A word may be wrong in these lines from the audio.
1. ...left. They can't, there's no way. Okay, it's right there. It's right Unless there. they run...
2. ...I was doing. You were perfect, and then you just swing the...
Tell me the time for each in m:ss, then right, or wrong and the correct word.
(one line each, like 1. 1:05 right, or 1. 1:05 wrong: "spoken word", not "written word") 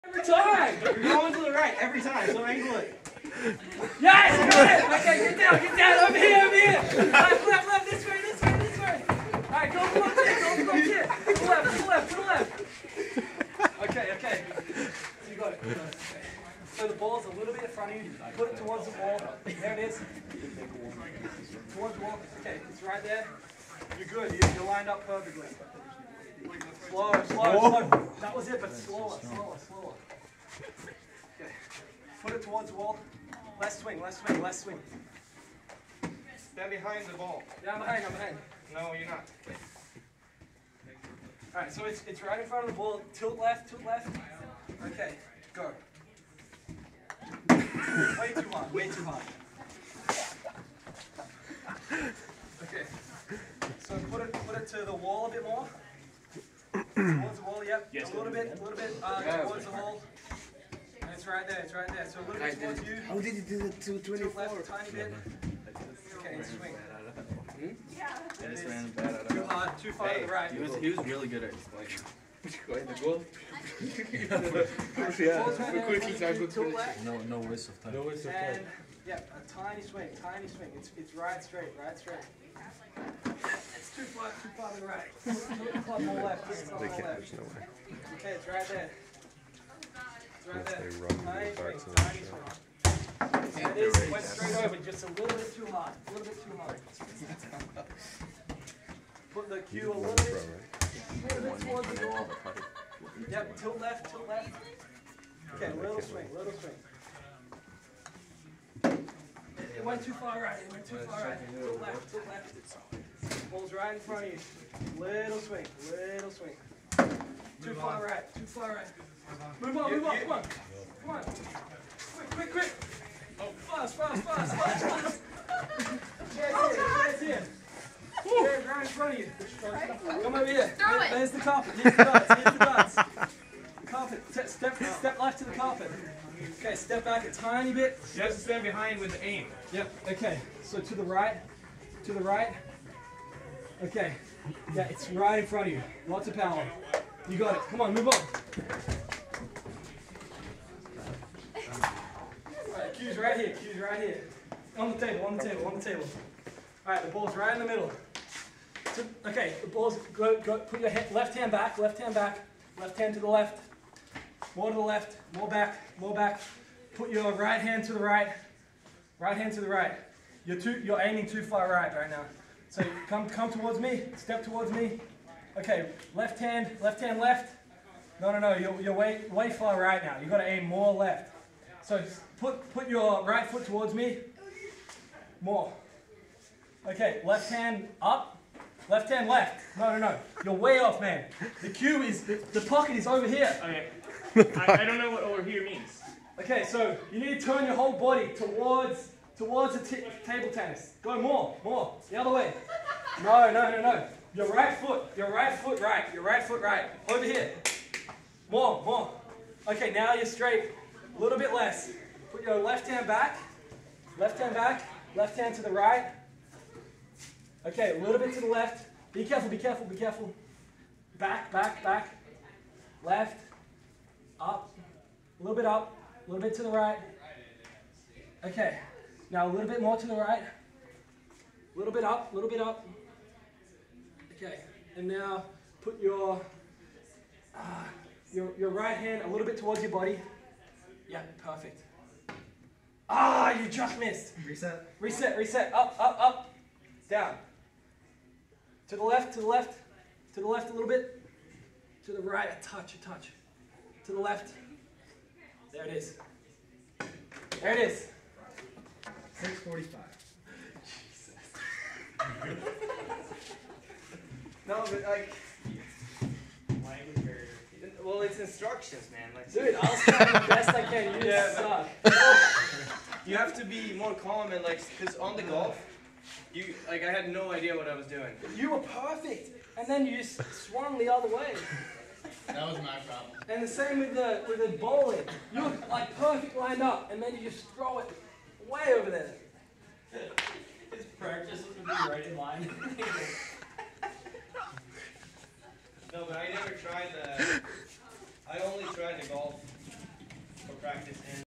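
1. 1:26 right
2. 4:37 wrong: "swung", not "swing".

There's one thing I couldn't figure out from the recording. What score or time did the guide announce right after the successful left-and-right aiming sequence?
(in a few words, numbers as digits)
6:45.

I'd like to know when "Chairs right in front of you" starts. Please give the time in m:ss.
2:08.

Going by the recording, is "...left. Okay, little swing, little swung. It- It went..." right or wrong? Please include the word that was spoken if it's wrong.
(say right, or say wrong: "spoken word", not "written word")
wrong: "swing", not "swung".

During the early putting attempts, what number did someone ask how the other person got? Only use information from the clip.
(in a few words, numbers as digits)
224.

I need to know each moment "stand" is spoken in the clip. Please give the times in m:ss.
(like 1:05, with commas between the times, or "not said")
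0:36, 2:18.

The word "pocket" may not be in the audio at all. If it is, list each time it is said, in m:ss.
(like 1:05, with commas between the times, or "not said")
3:12.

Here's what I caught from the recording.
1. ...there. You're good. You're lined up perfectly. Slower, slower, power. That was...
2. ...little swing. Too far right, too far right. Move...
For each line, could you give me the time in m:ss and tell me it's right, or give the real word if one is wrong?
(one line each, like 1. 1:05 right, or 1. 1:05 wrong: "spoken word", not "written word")
1. 0:23 wrong: "slower", not "power"
2. 1:55 right.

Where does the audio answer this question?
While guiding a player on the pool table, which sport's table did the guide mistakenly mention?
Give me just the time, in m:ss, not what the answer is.
3:20.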